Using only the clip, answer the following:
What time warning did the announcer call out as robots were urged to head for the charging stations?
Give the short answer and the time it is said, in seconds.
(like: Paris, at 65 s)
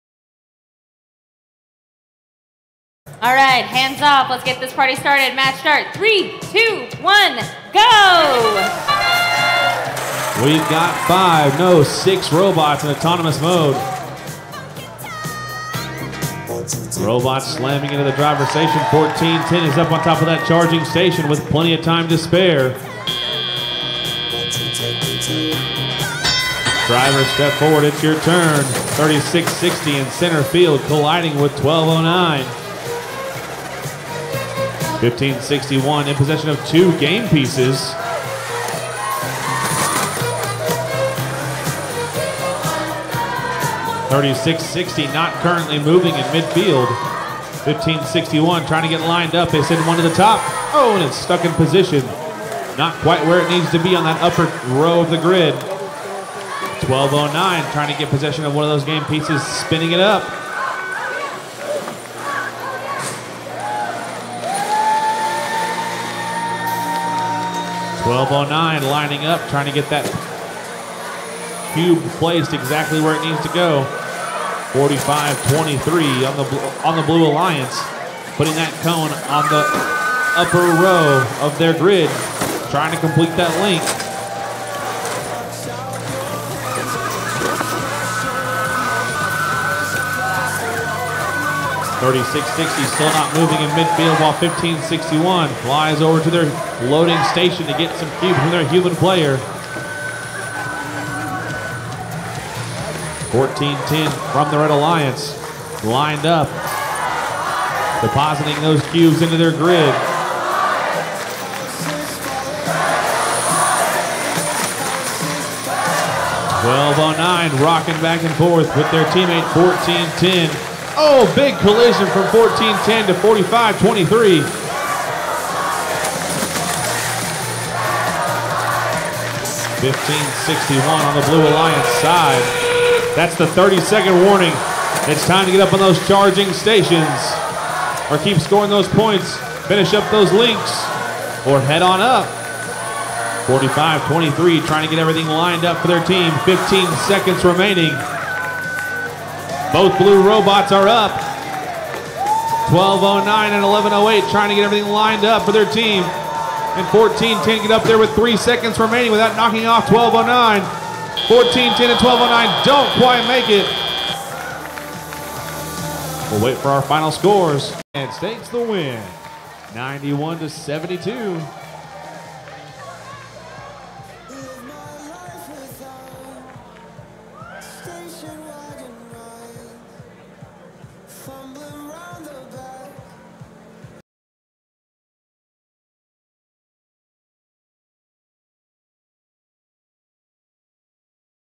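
30-second warning, at 133 s.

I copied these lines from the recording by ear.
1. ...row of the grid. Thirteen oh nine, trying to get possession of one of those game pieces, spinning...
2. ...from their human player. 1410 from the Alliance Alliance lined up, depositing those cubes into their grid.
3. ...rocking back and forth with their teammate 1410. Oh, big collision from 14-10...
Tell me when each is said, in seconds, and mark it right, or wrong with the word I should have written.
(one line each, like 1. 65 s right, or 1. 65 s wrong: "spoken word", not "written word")
1. 54 s wrong: "Twelve", not "Thirteen"
2. 98 s wrong: "Red", not "Alliance"
3. 117 s right.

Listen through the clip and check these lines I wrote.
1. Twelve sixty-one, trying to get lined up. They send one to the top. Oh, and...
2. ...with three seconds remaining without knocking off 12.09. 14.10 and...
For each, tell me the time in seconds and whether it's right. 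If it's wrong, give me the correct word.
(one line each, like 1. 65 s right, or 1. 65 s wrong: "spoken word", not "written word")
1. 47 s wrong: "Fifteen", not "Twelve"
2. 157 s right.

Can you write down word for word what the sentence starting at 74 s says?
45-23 on the on the Blue Alliance, putting that cone on the upper row of their grid, trying to complete that link.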